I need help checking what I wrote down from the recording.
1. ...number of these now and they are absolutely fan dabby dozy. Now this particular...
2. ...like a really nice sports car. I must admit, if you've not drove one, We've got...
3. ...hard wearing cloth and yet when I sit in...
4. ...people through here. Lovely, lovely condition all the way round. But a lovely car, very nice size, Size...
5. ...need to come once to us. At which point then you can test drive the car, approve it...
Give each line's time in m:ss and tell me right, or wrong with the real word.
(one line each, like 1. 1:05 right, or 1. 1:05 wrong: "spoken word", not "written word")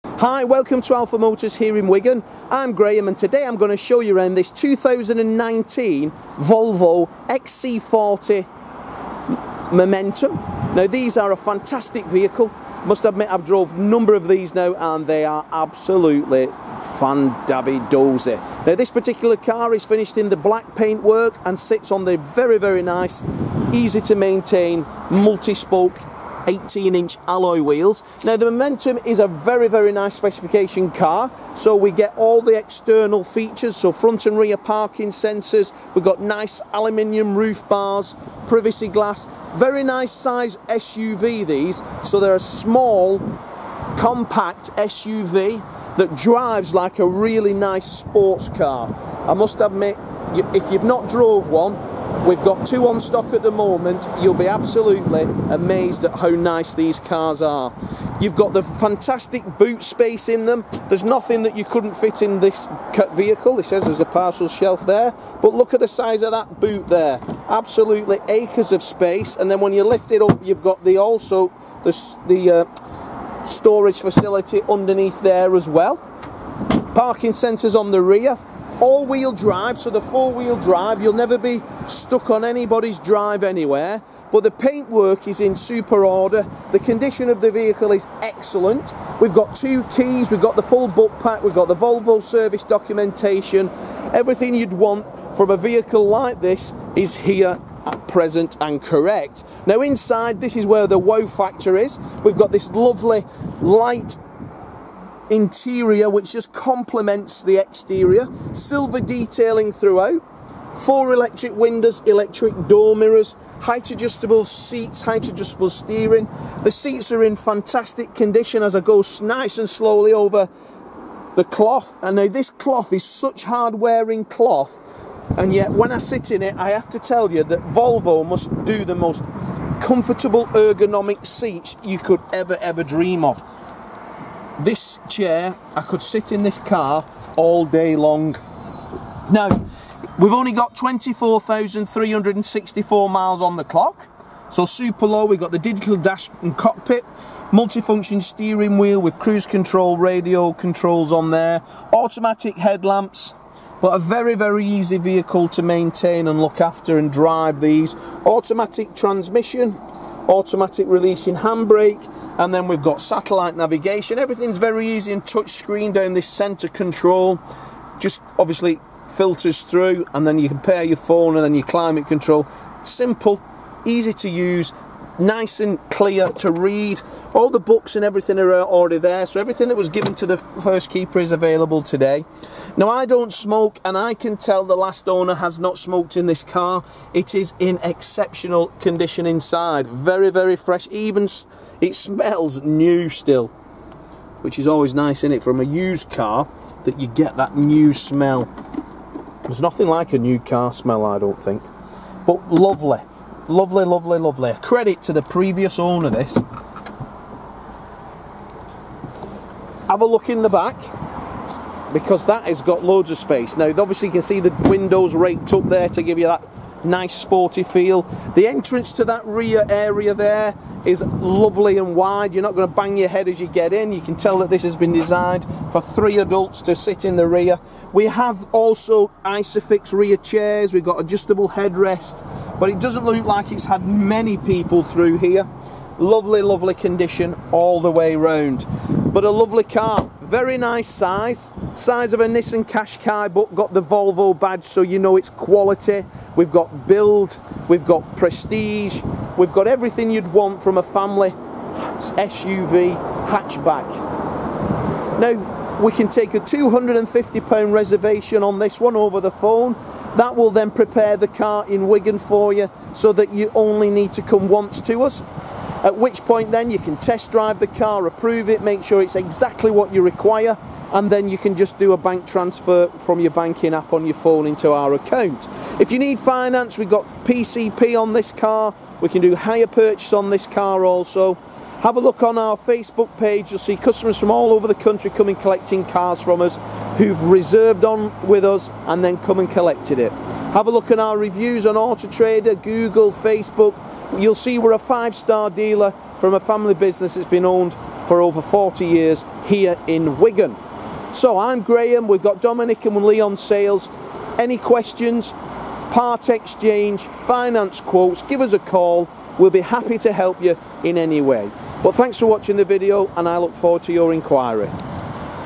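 1. 0:13 right
2. 0:46 right
3. 2:03 right
4. 3:54 right
5. 4:23 right.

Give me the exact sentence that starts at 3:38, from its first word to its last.
The entrance to that rear area there is lovely and wide.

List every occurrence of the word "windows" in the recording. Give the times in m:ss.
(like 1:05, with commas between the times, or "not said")
1:51, 3:34.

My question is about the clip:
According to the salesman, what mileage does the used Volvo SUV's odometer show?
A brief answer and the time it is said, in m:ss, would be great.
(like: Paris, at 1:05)
24,364, at 2:20.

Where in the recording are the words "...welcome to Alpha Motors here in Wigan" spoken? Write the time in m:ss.
0:00.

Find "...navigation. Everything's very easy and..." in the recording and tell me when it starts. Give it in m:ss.
2:43.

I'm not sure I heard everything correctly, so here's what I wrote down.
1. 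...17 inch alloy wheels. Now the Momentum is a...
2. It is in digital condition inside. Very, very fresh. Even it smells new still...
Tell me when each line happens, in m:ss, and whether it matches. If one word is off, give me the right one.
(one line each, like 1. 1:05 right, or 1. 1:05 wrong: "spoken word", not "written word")
1. 0:26 wrong: "18", not "17"
2. 3:07 wrong: "exceptional", not "digital".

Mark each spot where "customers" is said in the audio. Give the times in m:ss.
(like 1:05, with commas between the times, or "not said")
4:43.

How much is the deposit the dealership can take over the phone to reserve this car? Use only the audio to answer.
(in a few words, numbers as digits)
£250.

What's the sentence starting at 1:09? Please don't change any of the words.
And then when you lift it up, you've got the also the, the uh, storage facility underneath there as well.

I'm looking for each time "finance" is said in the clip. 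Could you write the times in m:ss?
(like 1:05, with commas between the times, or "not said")
4:36, 5:07.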